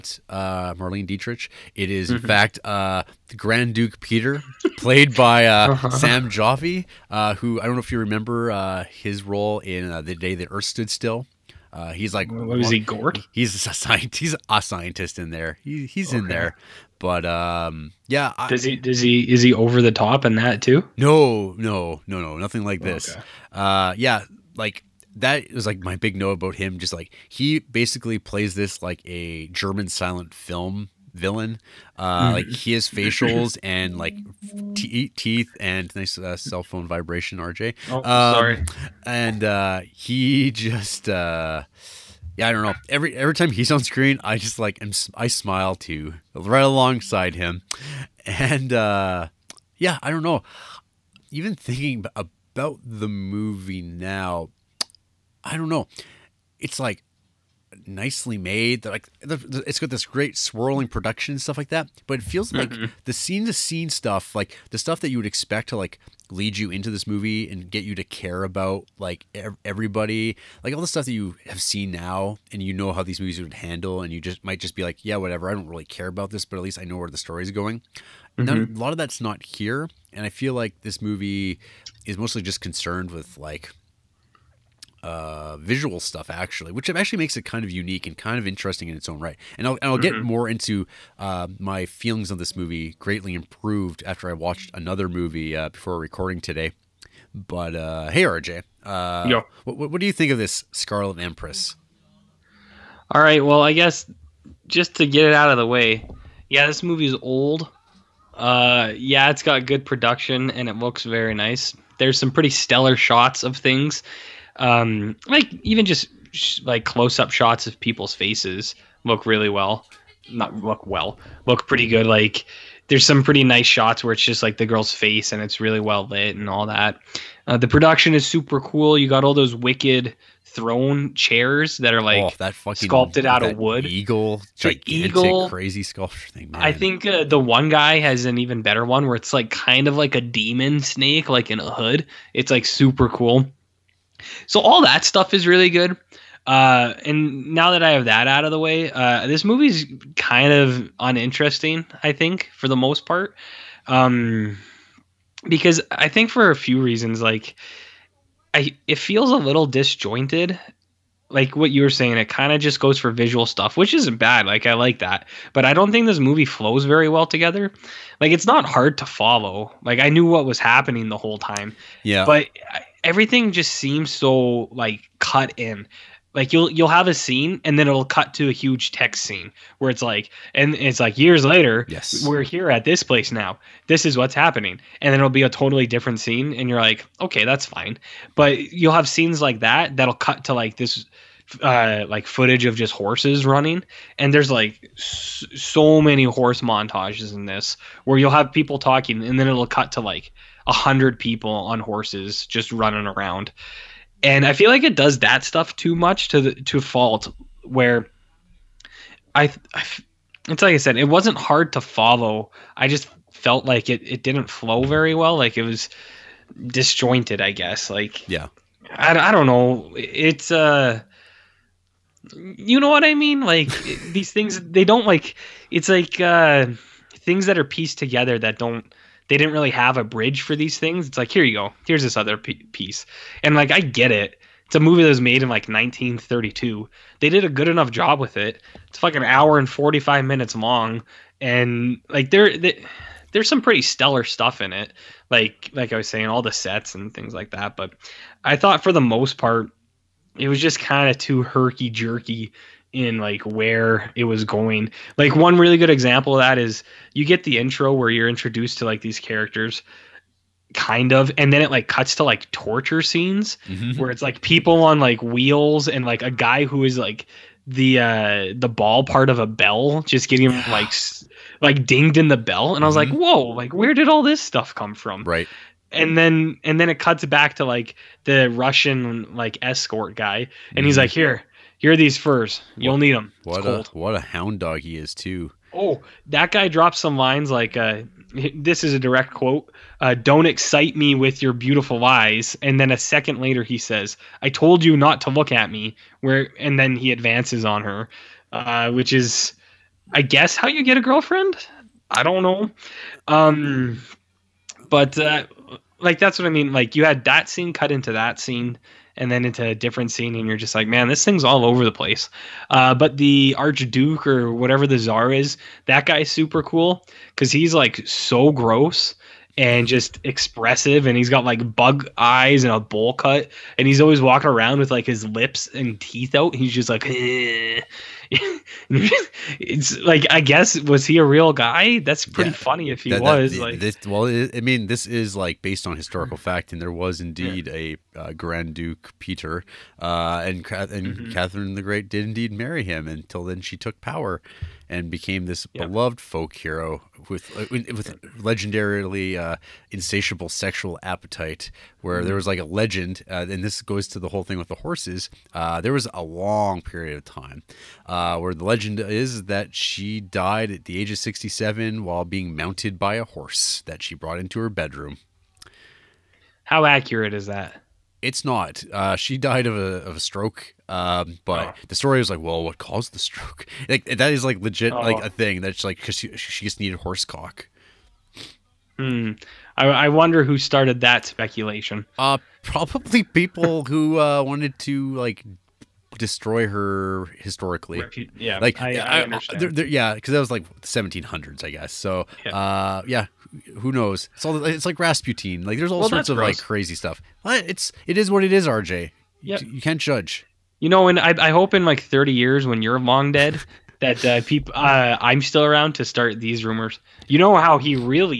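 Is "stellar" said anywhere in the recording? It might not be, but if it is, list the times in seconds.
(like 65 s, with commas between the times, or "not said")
112 s, 243 s.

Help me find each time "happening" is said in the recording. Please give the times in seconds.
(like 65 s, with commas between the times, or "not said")
170 s, 184 s.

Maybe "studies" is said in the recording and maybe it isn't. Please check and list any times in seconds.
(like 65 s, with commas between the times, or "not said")
not said.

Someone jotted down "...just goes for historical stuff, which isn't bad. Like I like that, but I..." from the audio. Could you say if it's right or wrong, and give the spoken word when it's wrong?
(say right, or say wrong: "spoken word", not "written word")
wrong: "visual", not "historical".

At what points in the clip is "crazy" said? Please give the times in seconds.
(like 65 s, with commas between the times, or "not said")
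135 s, 396 s.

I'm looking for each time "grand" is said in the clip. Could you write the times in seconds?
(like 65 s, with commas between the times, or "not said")
3 s, 338 s.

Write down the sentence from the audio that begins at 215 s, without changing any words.
Like it was disjointed, I guess.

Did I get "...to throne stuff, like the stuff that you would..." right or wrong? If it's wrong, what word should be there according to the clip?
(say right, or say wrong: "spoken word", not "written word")
wrong: "scene", not "throne".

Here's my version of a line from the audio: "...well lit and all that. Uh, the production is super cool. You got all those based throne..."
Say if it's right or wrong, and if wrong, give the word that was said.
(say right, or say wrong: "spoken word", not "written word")
wrong: "wicked", not "based".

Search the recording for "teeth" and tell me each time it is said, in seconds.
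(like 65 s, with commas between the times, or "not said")
34 s, 325 s.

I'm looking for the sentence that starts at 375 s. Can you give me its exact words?
like a thing that's like because she, she just needed horse cock.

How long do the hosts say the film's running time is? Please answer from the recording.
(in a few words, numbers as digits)
1 hour 45 minutes.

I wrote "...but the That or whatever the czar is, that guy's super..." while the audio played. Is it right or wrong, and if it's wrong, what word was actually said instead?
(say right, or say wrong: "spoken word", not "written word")
wrong: "Archduke", not "That".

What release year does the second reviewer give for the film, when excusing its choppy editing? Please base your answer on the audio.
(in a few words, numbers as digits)
1932.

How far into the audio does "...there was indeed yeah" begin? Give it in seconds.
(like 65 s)
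336 s.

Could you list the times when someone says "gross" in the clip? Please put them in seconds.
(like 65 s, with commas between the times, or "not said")
318 s, 396 s.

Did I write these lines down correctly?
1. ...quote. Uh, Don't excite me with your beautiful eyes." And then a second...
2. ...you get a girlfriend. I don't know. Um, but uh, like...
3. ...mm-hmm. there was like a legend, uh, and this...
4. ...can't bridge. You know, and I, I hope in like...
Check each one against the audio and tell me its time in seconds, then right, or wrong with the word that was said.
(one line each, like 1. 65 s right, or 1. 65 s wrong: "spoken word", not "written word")
1. 289 s right
2. 300 s right
3. 352 s right
4. 399 s wrong: "judge", not "bridge".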